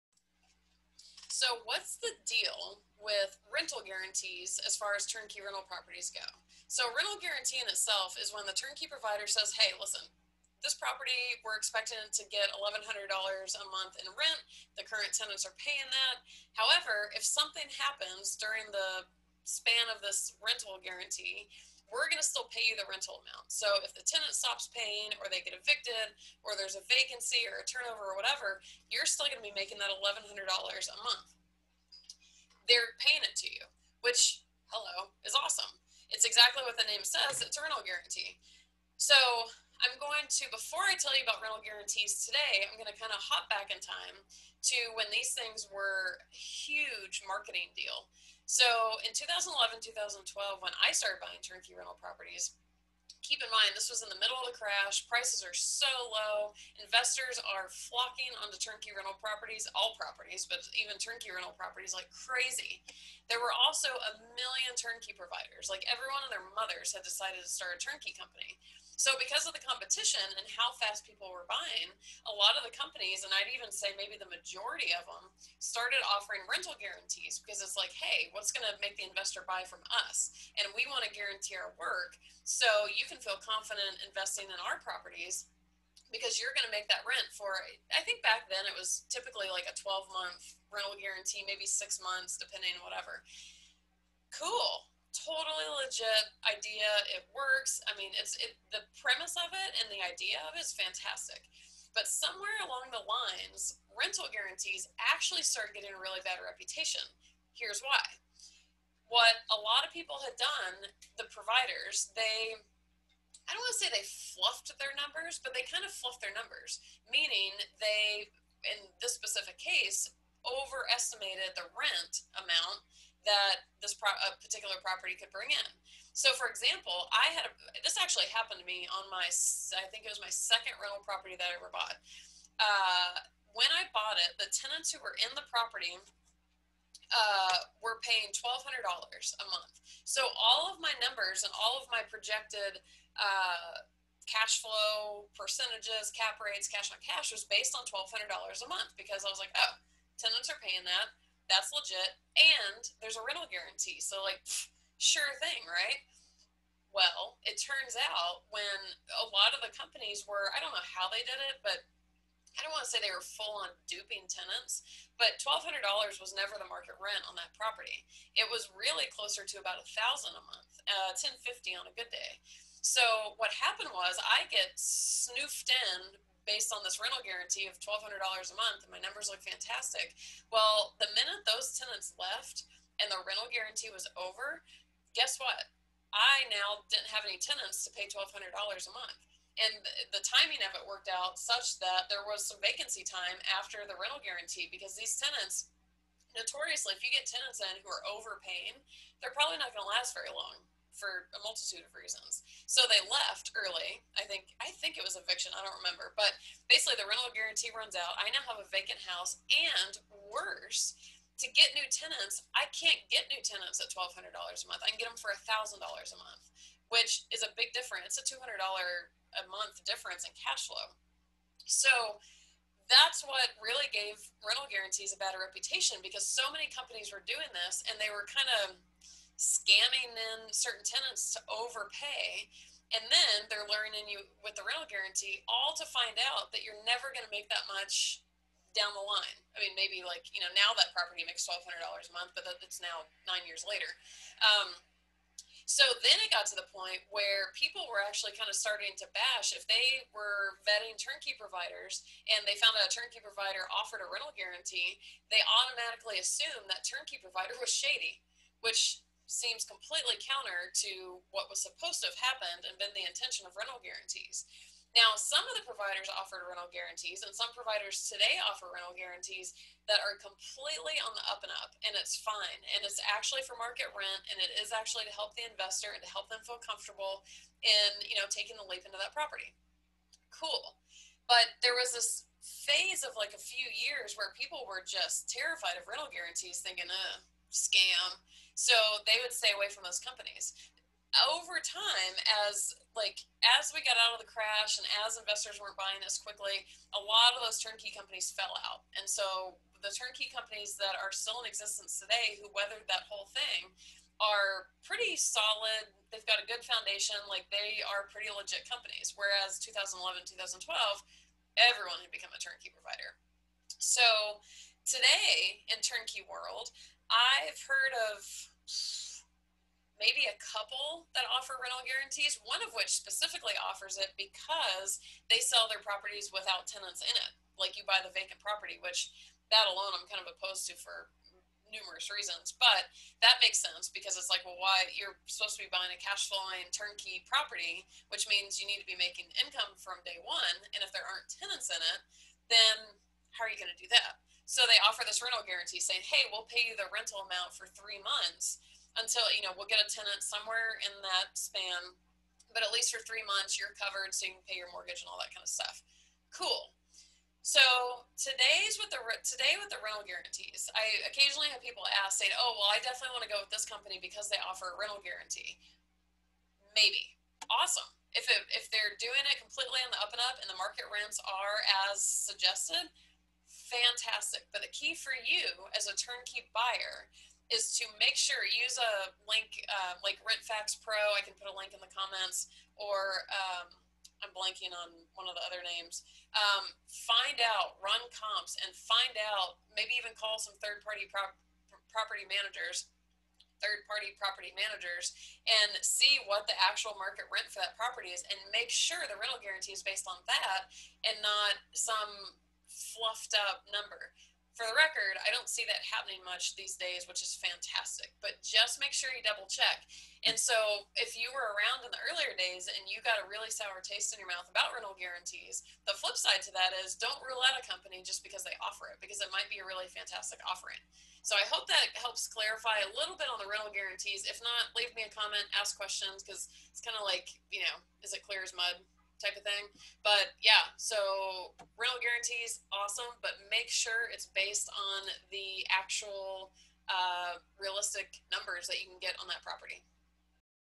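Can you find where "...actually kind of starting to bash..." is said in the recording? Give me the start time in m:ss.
4:08.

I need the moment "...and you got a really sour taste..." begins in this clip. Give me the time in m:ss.
6:52.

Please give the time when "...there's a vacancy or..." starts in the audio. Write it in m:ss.
0:26.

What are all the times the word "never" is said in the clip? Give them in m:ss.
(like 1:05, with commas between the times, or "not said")
2:46, 3:56.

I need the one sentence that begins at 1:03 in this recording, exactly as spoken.
There were also a million turnkey providers.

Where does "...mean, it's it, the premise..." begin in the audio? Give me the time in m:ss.
1:37.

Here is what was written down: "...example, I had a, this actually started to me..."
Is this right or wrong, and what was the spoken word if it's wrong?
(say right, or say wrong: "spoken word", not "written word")
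wrong: "happened", not "started".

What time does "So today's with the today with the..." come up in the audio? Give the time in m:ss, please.
5:57.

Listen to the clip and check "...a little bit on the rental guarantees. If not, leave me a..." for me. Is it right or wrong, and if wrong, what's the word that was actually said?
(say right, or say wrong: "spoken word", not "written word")
right.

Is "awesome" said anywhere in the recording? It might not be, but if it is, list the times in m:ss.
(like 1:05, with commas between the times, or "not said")
0:35, 6:07, 7:12.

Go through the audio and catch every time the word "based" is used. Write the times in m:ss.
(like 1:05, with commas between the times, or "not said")
2:27, 2:56, 6:39, 7:14.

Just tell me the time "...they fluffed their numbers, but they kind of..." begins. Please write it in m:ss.
1:53.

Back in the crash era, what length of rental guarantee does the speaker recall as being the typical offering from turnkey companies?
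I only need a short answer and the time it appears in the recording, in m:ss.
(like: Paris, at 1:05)
12 months, at 1:29.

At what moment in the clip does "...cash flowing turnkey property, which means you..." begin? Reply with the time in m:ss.
5:36.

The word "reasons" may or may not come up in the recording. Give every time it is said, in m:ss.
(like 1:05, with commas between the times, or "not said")
3:21, 5:32.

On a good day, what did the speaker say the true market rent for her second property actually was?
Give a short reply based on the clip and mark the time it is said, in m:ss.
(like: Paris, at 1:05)
1050, at 2:51.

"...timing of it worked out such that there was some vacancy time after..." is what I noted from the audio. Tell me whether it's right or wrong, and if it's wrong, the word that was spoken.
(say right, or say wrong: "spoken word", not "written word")
right.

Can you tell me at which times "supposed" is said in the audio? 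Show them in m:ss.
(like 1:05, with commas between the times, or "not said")
4:21, 5:35.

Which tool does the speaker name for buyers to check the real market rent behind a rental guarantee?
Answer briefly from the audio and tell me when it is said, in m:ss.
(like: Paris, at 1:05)
RentFax Pro, at 6:20.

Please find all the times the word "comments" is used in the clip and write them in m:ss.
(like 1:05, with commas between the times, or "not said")
6:21, 7:05.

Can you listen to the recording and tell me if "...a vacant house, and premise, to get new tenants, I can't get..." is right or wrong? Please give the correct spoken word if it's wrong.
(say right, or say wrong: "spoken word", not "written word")
wrong: "worse", not "premise".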